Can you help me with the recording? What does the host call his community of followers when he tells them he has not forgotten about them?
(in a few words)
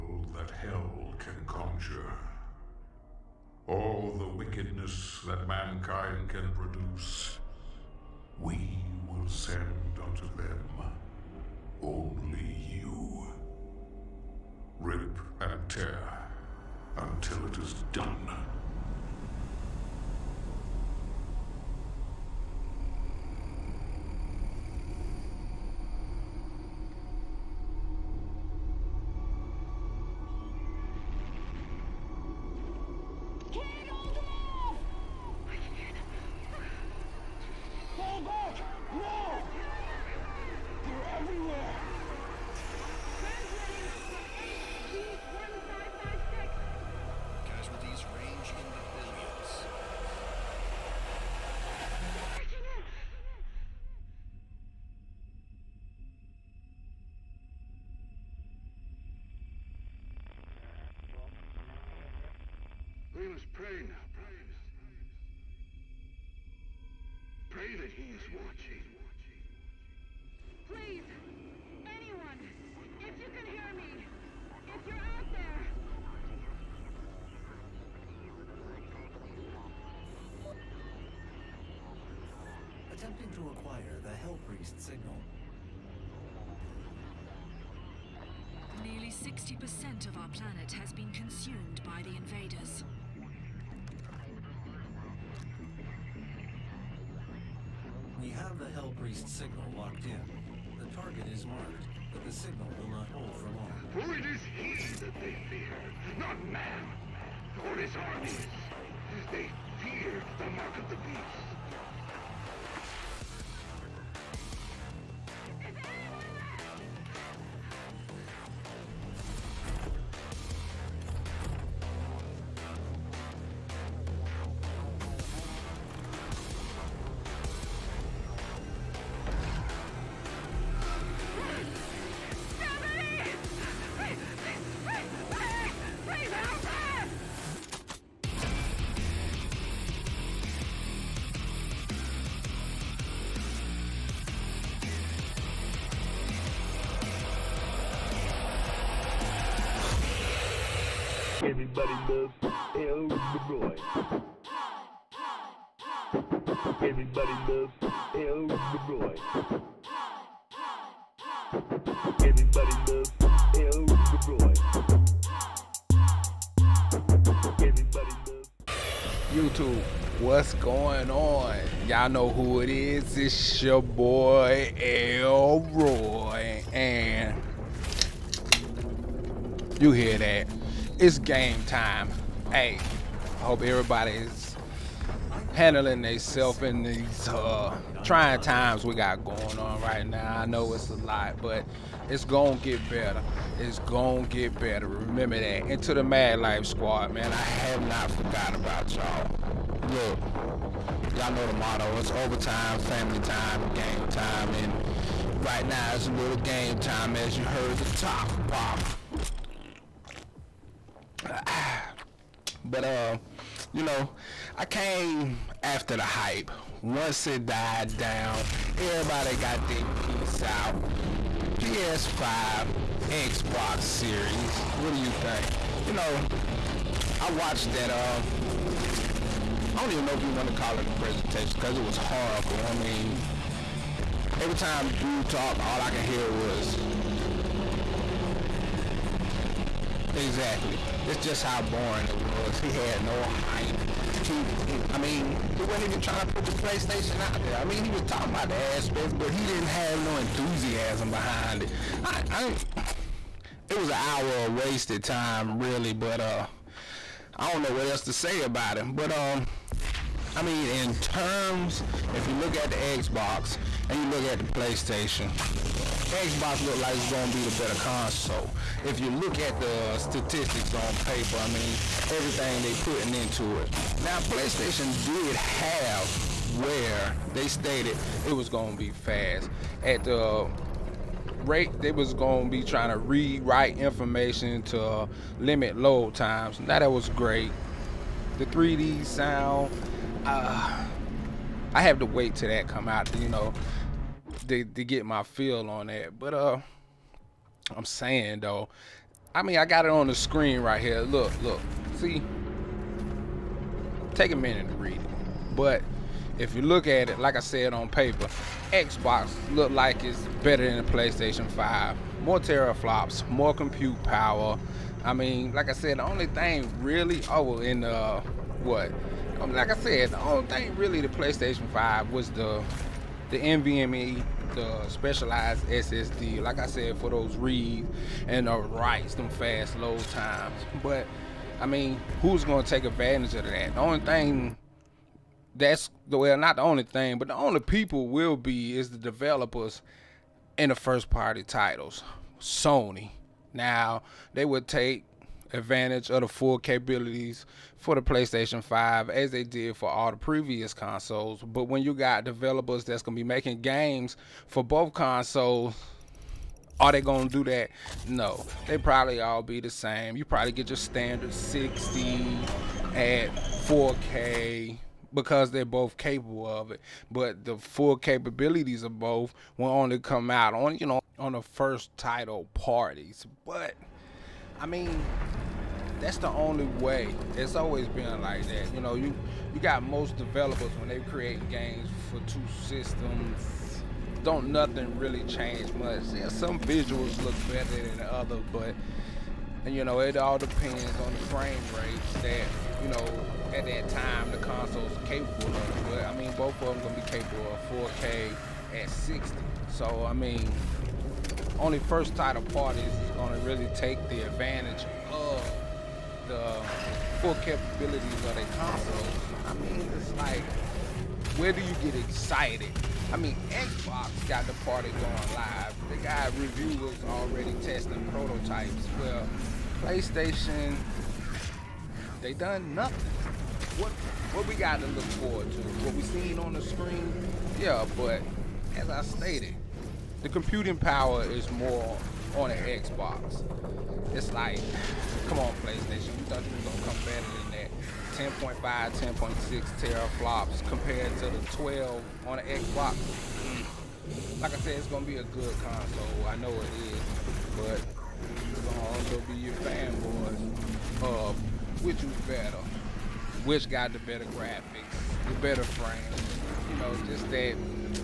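MAG Life Squad.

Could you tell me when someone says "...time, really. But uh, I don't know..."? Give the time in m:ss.
4:15.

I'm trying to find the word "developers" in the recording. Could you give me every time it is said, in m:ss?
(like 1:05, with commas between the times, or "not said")
5:38, 5:52, 6:20.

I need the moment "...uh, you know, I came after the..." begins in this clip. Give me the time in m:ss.
3:32.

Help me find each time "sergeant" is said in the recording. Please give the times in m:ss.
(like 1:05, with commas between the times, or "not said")
not said.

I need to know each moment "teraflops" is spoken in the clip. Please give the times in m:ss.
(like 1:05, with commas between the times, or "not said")
5:12, 7:19.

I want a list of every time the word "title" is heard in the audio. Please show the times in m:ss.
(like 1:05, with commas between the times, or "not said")
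5:41, 6:11, 6:42.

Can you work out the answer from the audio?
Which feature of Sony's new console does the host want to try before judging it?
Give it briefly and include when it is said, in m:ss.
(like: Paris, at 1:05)
3D sound, at 4:48.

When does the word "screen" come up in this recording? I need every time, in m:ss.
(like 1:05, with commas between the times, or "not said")
5:00, 7:06.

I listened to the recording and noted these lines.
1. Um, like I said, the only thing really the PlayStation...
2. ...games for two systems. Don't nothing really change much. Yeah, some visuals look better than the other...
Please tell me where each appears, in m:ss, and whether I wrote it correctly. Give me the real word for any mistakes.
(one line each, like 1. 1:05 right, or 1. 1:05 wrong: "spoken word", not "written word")
1. 5:19 right
2. 6:21 right.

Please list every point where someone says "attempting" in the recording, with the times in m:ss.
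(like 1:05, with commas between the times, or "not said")
1:22.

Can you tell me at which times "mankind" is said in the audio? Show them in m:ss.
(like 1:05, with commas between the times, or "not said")
0:05.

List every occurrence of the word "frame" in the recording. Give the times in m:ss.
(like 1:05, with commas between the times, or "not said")
6:31, 7:35.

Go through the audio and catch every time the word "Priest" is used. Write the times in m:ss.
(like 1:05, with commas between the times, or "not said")
1:24, 1:38.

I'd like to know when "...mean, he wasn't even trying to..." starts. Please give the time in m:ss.
4:04.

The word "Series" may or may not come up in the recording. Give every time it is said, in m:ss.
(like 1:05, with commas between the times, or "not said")
3:43.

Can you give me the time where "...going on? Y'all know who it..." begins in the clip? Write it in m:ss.
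2:50.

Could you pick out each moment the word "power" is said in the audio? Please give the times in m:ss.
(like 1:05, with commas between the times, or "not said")
5:14, 7:10.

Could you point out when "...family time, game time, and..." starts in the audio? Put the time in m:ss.
3:22.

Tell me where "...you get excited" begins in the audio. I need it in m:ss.
6:51.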